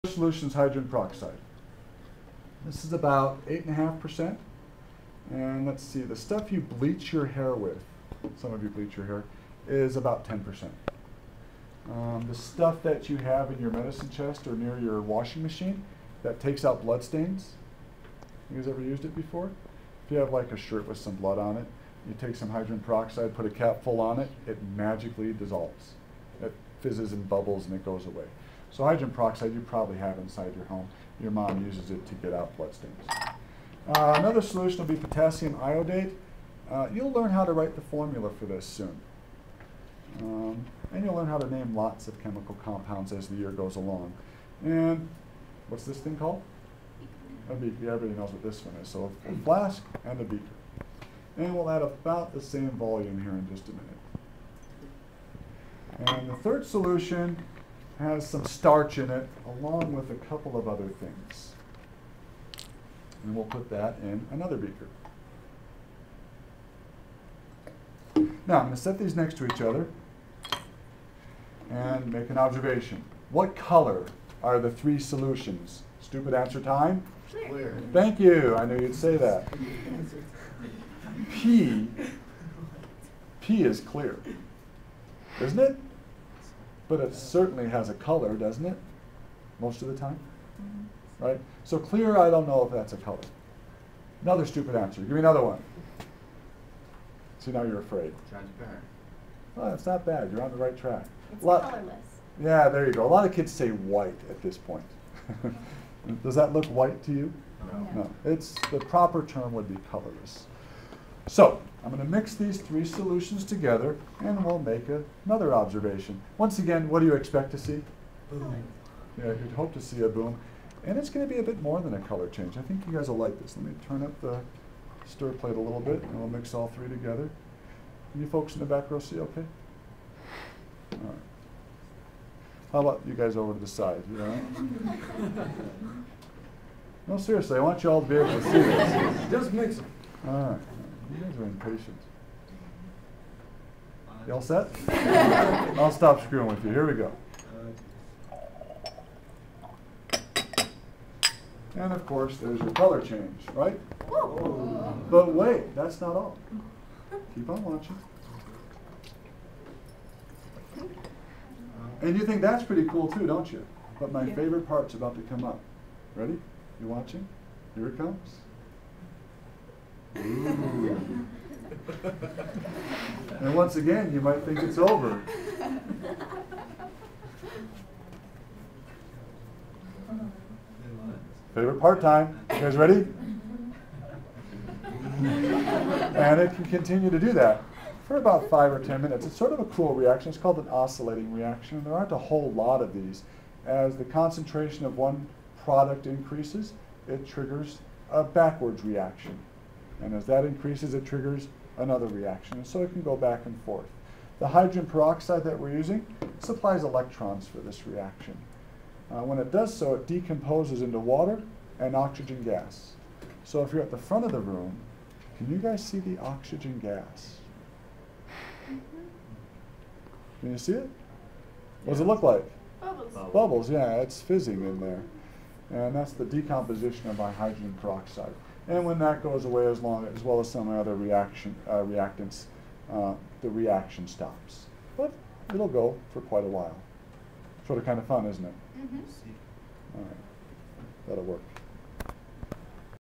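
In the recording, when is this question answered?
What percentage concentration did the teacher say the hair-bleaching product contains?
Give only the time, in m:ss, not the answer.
0:09.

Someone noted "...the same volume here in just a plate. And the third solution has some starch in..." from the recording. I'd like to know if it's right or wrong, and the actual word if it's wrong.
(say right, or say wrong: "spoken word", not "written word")
wrong: "minute", not "plate".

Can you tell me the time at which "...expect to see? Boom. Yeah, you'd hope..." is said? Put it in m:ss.
1:57.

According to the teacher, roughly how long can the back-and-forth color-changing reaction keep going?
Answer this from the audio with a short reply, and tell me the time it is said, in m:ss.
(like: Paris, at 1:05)
5 or 10 minutes, at 3:08.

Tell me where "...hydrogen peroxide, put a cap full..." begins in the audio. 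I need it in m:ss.
0:22.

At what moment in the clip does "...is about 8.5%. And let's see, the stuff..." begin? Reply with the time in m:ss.
0:02.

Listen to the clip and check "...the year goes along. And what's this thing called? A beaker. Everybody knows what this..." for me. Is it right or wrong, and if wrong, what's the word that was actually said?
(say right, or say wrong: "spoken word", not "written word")
right.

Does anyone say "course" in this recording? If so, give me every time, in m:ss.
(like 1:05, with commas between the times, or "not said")
2:32.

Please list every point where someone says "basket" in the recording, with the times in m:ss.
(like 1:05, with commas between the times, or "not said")
not said.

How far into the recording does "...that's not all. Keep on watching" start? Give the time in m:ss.
2:35.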